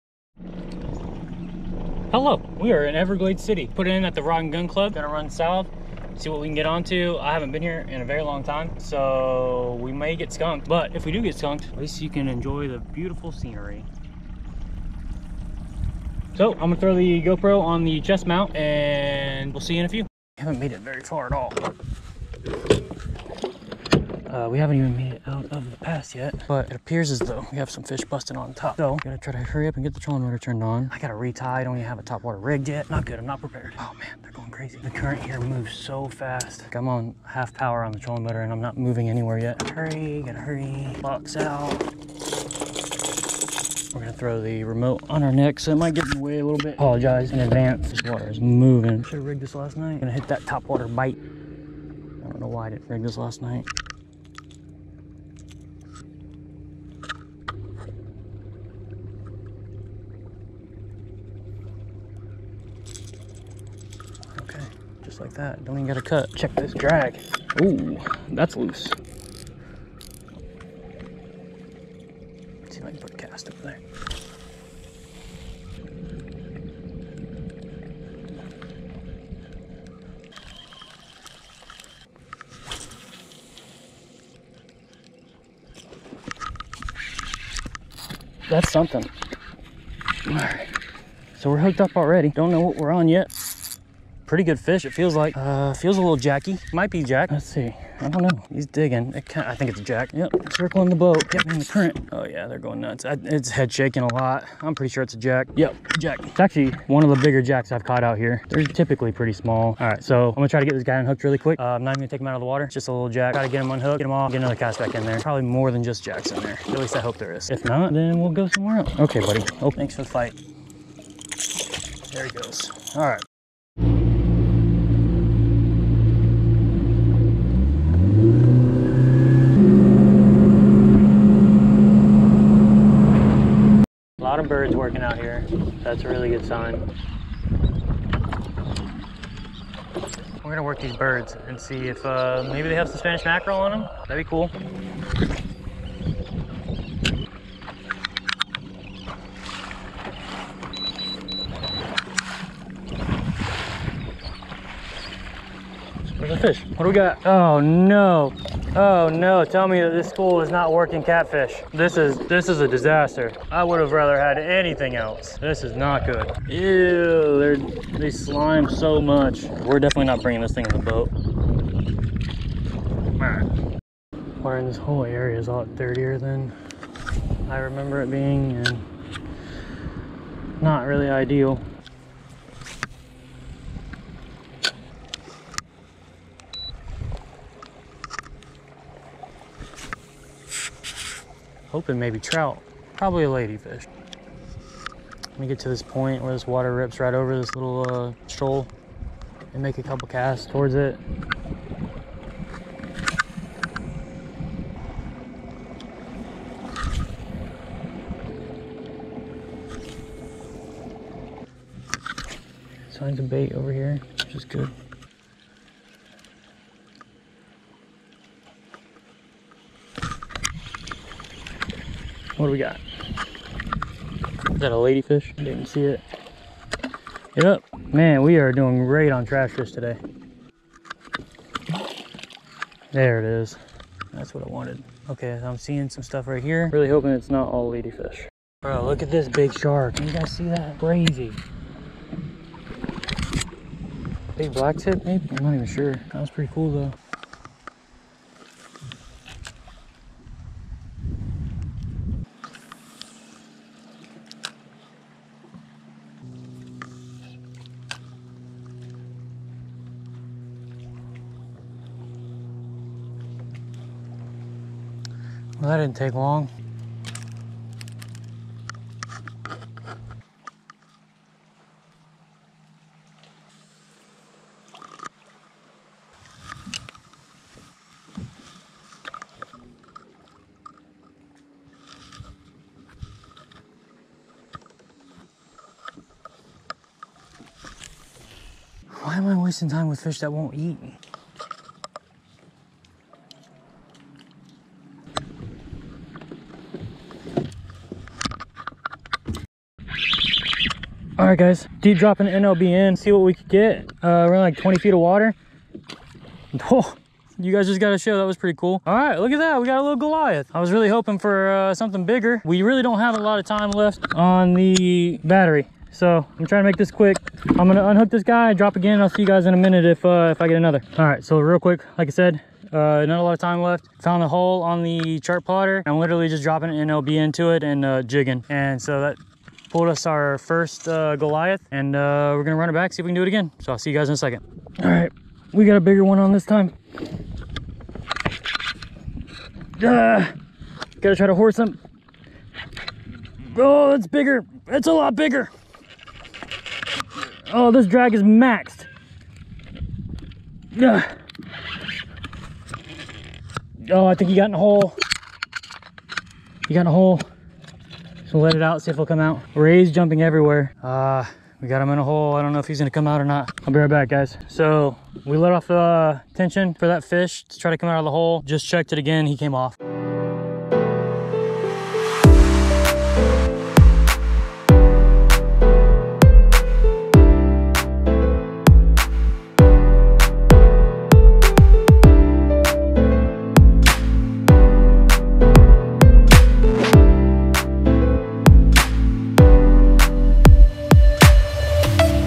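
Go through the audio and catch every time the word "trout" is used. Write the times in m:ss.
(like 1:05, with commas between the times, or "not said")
3:12.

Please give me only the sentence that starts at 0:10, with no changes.
But if we do get skunked, at least you can enjoy the beautiful scenery.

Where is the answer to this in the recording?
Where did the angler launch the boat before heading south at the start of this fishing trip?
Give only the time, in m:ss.
0:04.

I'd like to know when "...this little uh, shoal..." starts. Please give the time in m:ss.
3:17.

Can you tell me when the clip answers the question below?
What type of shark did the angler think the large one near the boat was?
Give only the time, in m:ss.
4:04.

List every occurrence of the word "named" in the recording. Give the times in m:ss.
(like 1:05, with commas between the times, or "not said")
not said.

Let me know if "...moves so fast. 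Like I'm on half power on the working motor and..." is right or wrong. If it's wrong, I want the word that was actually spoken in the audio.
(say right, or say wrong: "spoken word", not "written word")
wrong: "trolling", not "working".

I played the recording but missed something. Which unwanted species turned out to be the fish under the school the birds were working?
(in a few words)
catfish.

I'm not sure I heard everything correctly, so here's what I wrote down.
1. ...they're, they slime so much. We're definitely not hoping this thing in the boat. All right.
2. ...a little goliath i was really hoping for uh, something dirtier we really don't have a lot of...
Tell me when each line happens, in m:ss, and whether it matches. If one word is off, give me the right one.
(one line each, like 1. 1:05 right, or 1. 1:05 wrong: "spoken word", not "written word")
1. 2:47 wrong: "bringing", not "hoping"
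2. 5:09 wrong: "bigger", not "dirtier".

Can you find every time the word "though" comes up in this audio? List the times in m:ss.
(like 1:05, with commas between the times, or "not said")
0:27, 4:06.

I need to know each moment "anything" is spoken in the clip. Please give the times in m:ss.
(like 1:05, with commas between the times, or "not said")
2:44.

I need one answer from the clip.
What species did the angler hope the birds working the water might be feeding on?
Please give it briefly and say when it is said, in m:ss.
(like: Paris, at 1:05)
Spanish mackerel, at 2:22.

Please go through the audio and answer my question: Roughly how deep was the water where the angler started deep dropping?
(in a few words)
20 feet.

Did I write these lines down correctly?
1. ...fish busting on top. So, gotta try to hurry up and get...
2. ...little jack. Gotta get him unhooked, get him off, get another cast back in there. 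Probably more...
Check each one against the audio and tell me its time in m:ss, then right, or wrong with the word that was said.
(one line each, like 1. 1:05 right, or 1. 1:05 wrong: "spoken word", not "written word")
1. 0:27 right
2. 1:52 right.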